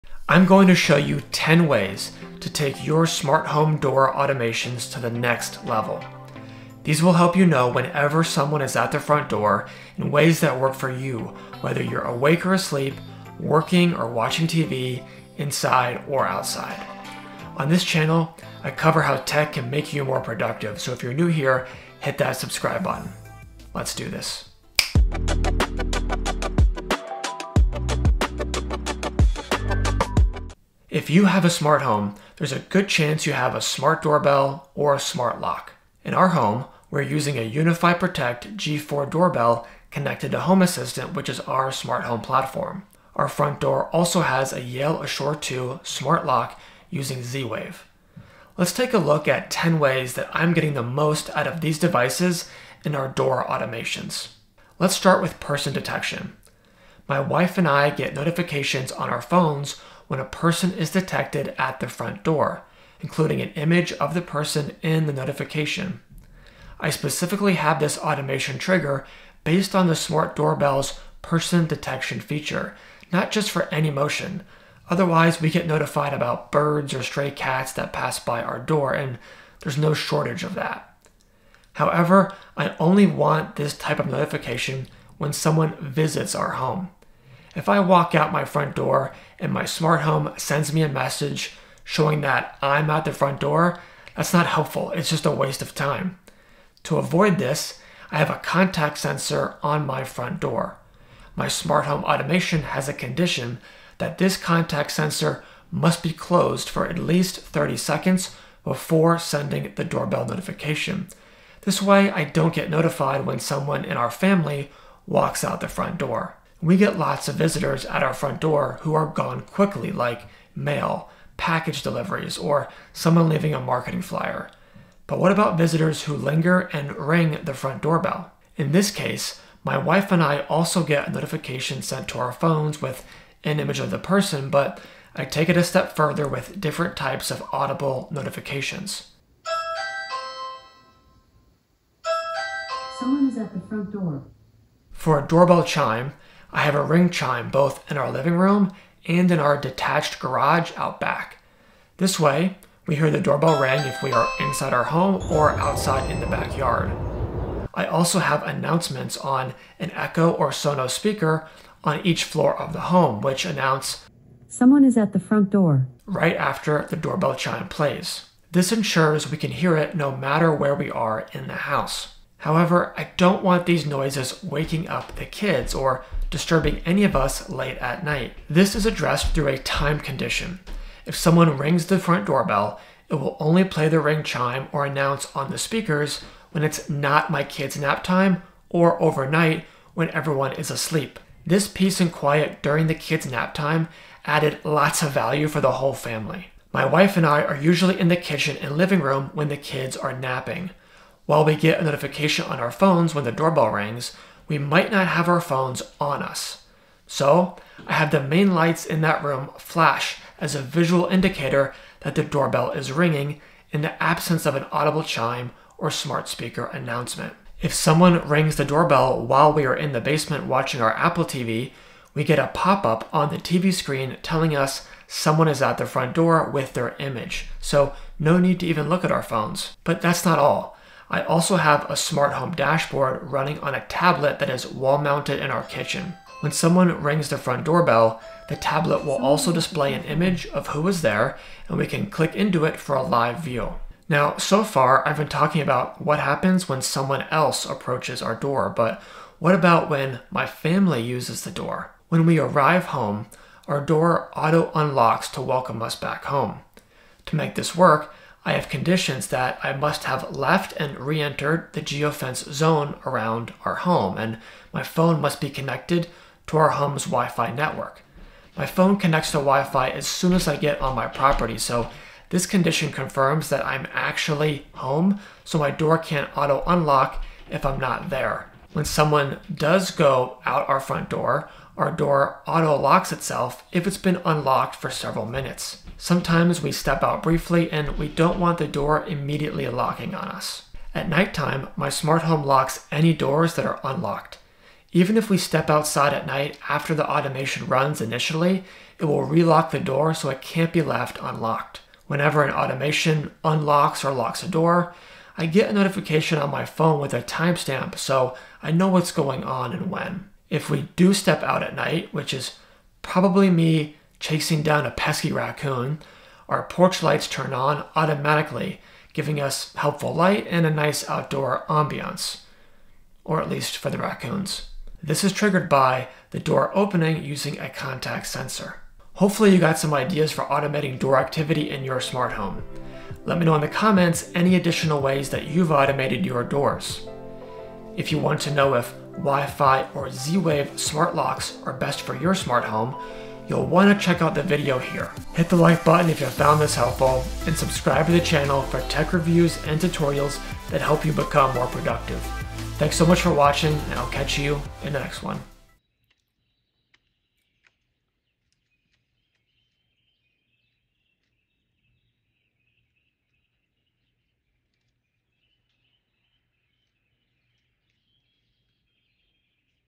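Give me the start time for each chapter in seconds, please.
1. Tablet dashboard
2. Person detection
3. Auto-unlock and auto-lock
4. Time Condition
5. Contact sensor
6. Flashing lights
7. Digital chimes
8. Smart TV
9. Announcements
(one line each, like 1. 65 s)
1. 229 s
2. 54 s
3. 251 s
4. 172 s
5. 81 s
6. 196 s
7. 144 s
8. 217 s
9. 157 s.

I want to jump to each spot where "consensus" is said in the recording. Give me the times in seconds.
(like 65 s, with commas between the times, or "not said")
not said.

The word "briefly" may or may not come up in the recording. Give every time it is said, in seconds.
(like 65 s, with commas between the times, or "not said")
287 s.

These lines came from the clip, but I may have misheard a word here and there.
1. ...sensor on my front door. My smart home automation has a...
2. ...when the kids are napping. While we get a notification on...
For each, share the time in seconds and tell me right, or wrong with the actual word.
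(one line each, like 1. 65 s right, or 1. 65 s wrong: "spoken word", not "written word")
1. 98 s right
2. 199 s right.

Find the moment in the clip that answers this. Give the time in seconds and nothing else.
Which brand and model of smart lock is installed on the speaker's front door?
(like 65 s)
44 s.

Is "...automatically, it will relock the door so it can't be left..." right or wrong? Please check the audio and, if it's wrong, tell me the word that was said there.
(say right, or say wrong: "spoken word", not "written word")
wrong: "initially", not "automatically".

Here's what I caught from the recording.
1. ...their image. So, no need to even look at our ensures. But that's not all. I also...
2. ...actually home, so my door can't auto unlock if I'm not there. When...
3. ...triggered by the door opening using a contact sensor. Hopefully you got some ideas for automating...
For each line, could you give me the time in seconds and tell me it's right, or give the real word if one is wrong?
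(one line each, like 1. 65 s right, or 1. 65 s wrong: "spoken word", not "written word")
1. 226 s wrong: "phones", not "ensures"
2. 273 s right
3. 325 s right.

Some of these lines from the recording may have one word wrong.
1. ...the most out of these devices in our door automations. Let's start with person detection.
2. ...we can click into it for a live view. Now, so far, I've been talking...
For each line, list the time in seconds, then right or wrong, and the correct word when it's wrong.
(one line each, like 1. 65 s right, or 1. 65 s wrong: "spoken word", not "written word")
1. 50 s right
2. 241 s right.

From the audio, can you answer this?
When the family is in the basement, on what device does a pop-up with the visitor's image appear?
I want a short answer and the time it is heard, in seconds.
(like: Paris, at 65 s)
Apple TV, at 220 s.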